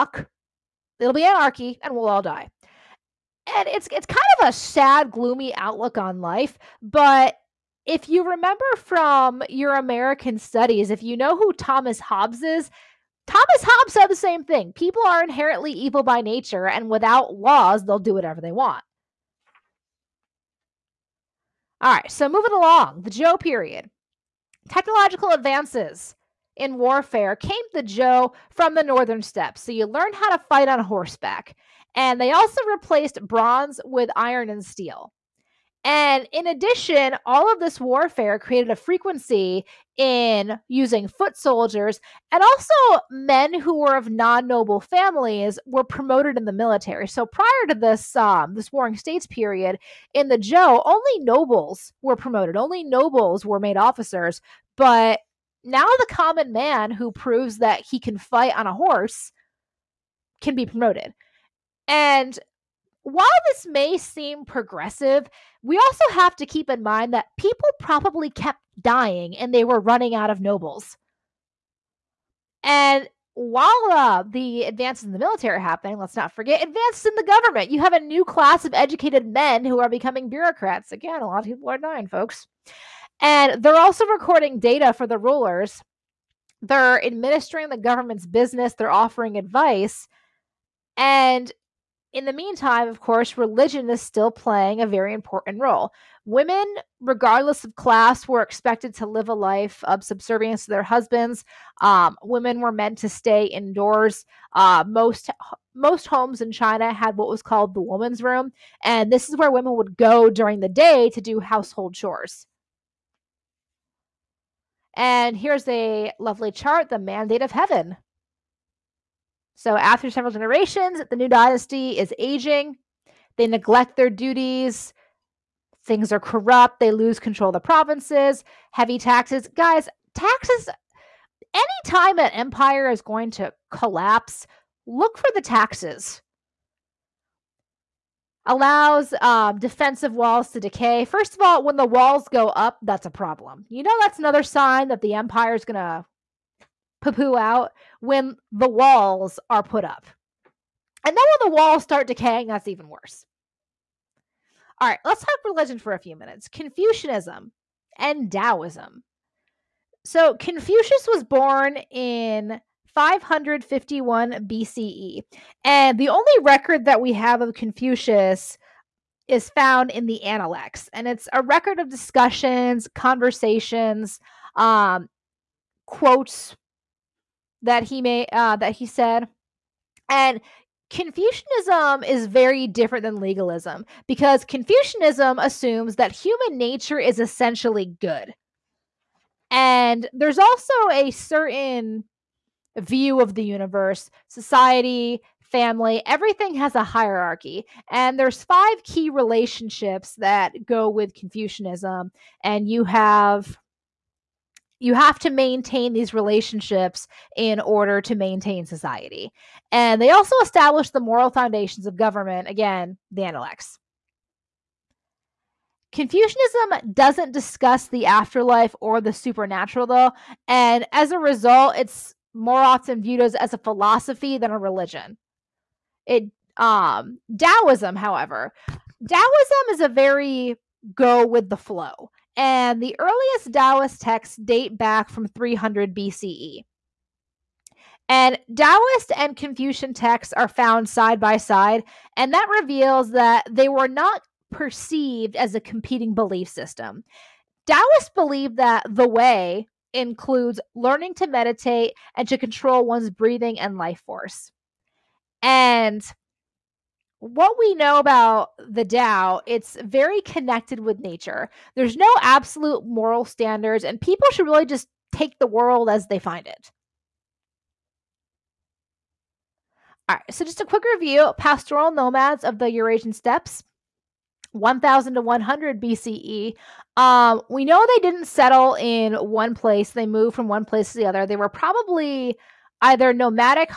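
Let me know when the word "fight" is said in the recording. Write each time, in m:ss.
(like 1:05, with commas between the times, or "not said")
0:30, 0:58.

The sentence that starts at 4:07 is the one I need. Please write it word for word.
Taoists believed that the way includes learning to meditate and to control one's breathing and life force.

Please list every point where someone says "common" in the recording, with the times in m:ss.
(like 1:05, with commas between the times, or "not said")
0:56.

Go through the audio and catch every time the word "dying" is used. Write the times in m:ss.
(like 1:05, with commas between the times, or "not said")
1:08, 1:21.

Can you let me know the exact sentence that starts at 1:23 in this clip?
And they're also recording data for the rulers.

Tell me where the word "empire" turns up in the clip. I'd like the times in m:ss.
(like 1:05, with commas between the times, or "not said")
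2:12, 2:25.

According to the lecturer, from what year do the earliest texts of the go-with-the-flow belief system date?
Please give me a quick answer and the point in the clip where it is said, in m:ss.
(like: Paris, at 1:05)
300 BCE, at 3:55.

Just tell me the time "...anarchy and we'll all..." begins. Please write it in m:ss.
0:01.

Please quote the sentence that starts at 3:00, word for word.
And Confucianism is very different than legalism because Confucianism assumes that human nature is essentially good.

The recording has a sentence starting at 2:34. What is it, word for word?
All right, let's talk religion for a few minutes Confucianism and Taoism.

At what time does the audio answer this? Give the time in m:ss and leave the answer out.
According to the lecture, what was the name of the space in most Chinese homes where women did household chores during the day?
1:47.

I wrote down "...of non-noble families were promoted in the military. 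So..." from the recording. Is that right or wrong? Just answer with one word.
right.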